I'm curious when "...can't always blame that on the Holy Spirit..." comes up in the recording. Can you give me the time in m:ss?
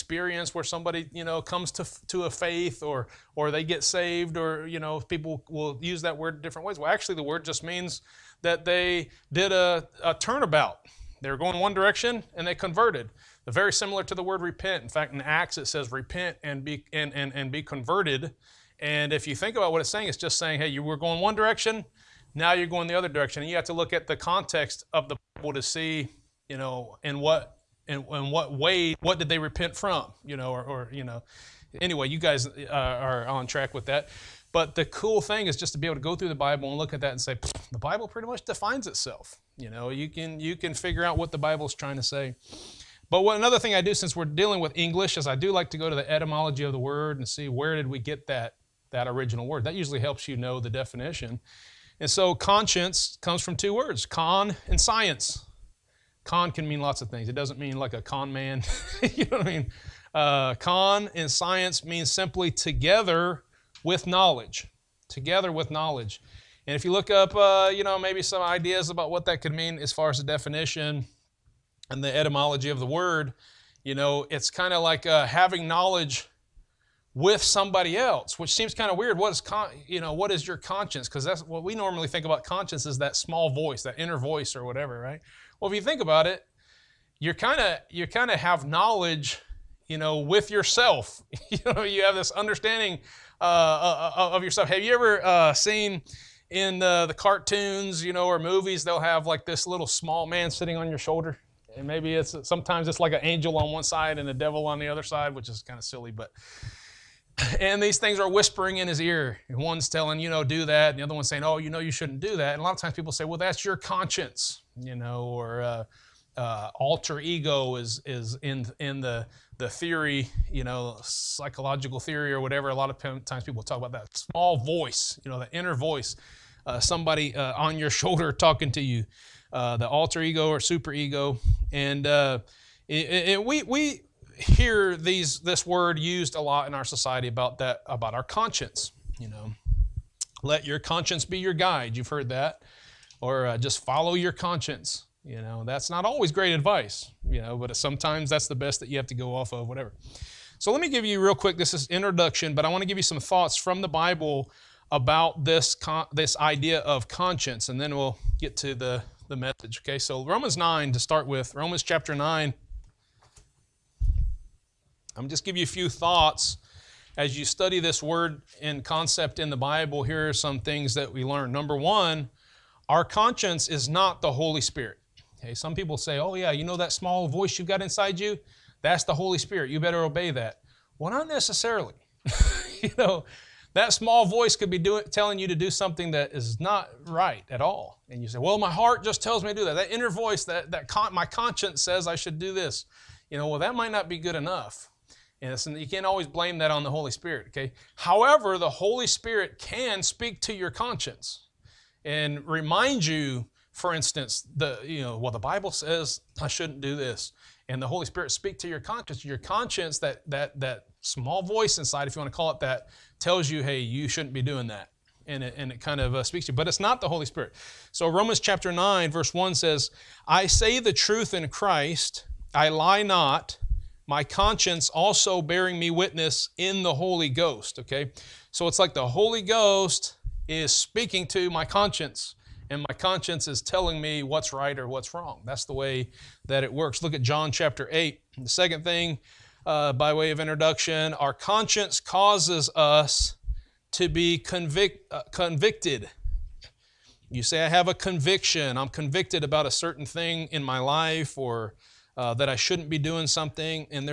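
3:15.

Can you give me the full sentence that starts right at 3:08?
And you say, well, my heart just tells me to do that.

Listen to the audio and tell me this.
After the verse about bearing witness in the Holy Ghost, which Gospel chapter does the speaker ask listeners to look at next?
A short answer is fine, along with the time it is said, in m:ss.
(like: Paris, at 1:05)
John 8, at 3:57.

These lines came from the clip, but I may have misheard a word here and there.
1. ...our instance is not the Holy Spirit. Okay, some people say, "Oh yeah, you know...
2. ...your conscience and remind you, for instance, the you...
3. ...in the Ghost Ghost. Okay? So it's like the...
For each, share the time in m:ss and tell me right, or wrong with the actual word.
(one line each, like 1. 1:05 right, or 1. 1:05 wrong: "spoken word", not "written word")
1. 2:52 wrong: "conscience", not "instance"
2. 3:20 right
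3. 3:46 wrong: "Holy", not "Ghost".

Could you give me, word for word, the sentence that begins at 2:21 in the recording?
You've heard that, or uh, just follow your conscience.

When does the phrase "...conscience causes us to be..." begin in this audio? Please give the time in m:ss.
4:01.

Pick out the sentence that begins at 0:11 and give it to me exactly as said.
They were going one direction and they converted.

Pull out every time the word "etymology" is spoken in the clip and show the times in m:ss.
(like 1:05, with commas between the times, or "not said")
0:46, 1:12.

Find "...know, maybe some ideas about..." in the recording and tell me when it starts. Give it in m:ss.
1:07.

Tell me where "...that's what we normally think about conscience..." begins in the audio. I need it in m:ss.
1:21.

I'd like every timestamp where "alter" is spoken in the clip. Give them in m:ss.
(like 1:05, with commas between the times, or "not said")
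1:56, 2:09.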